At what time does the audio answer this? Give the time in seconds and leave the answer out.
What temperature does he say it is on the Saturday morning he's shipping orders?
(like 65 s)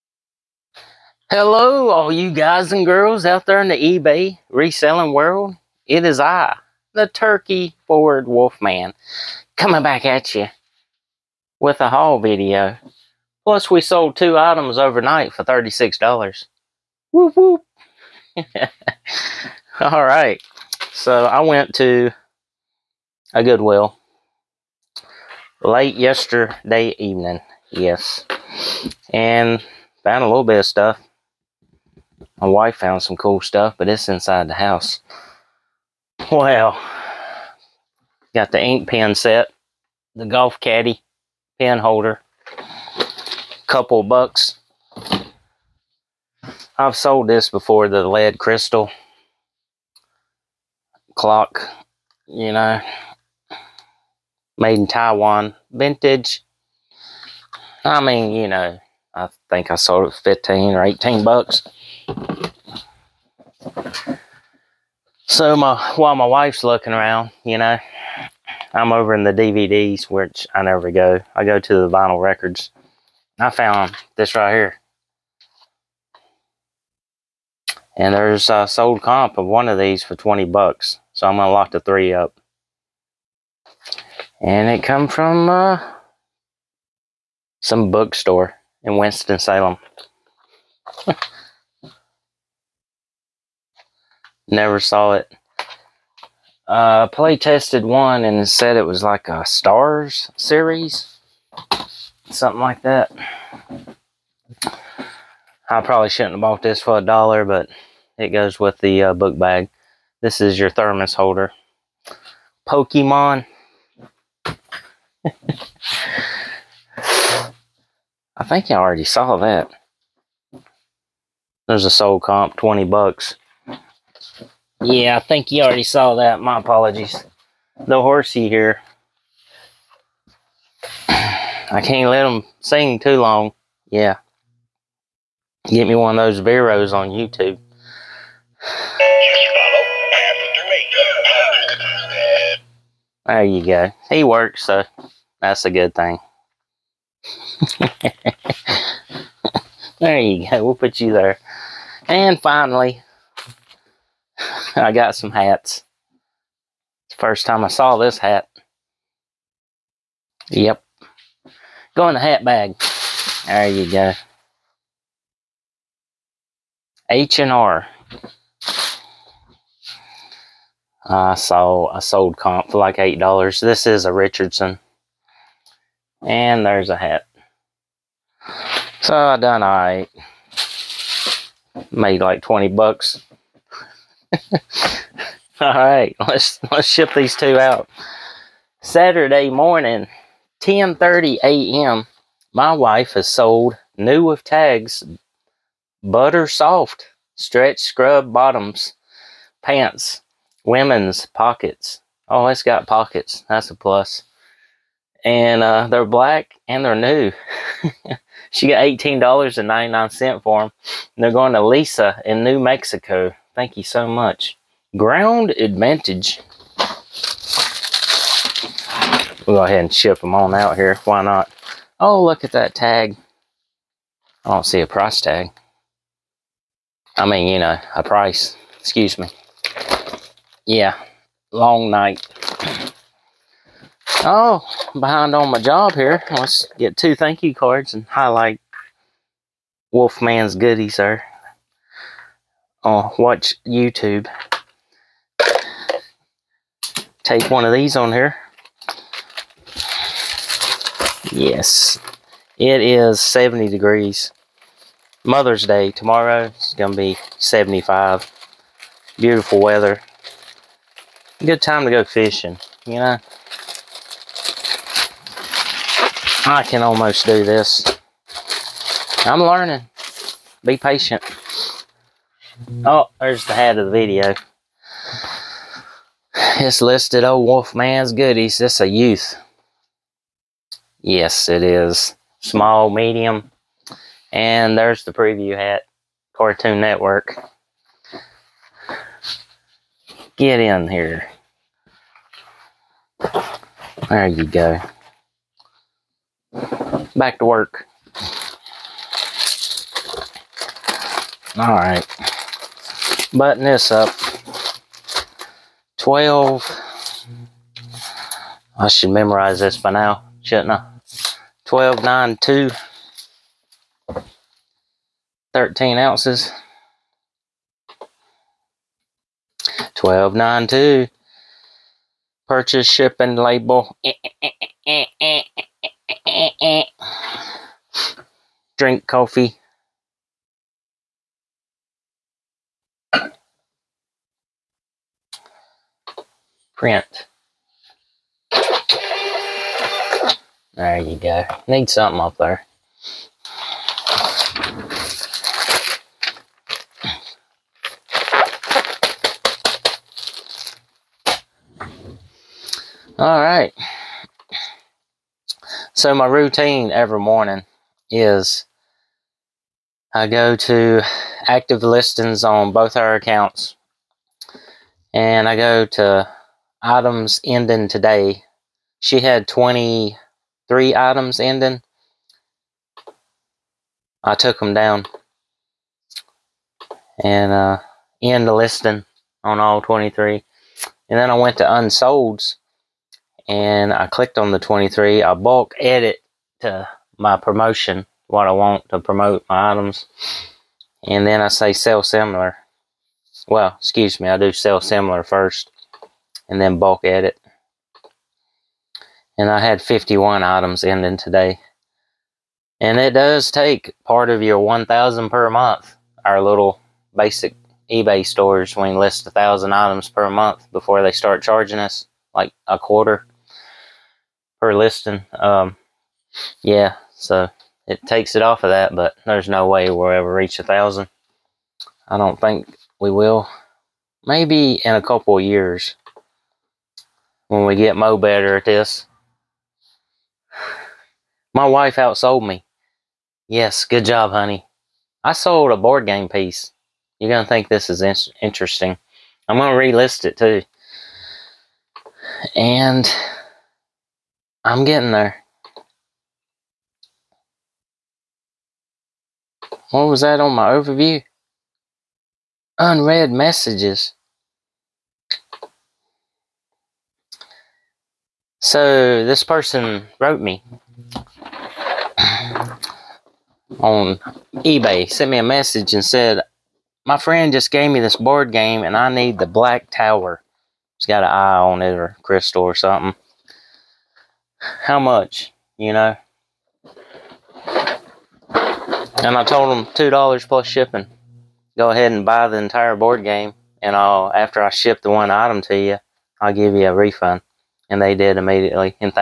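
253 s.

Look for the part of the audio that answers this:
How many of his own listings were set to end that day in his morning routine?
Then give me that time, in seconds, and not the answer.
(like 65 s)
399 s.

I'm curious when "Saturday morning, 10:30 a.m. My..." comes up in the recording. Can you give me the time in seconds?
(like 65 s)
188 s.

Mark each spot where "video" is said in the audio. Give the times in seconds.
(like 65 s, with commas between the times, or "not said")
12 s, 273 s.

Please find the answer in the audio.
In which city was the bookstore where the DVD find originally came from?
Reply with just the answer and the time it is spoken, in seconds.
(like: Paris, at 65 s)
Winston-Salem, at 88 s.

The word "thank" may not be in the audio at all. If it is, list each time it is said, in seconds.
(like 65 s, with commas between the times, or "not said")
213 s, 237 s.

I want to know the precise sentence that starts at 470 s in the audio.
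It's got an eye on it or crystal or something.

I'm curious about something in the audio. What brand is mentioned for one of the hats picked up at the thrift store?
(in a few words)
Richardson.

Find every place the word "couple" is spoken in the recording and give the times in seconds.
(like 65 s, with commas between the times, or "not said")
43 s, 425 s.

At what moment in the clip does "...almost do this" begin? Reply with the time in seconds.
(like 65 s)
266 s.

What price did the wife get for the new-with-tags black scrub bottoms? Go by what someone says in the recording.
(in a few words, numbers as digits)
$18.99.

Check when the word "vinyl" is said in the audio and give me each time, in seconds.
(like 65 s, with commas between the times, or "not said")
71 s.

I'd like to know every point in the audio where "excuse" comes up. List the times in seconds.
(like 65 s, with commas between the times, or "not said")
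228 s, 393 s.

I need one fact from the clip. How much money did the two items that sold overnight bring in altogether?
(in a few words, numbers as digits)
$36.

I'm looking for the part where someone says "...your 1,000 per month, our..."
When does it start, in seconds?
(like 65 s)
404 s.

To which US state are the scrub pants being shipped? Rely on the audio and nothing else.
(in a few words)
New Mexico.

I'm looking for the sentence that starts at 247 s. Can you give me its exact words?
Take one of these on here.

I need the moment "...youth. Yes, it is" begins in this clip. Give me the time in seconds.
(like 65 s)
278 s.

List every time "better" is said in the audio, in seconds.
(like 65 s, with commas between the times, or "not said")
428 s.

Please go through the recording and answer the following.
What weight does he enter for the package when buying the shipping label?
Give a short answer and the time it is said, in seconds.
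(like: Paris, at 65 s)
13 ounces, at 315 s.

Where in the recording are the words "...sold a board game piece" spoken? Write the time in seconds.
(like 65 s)
435 s.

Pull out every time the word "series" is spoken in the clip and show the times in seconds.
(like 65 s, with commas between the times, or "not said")
100 s.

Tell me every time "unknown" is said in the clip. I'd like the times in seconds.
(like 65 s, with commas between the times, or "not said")
not said.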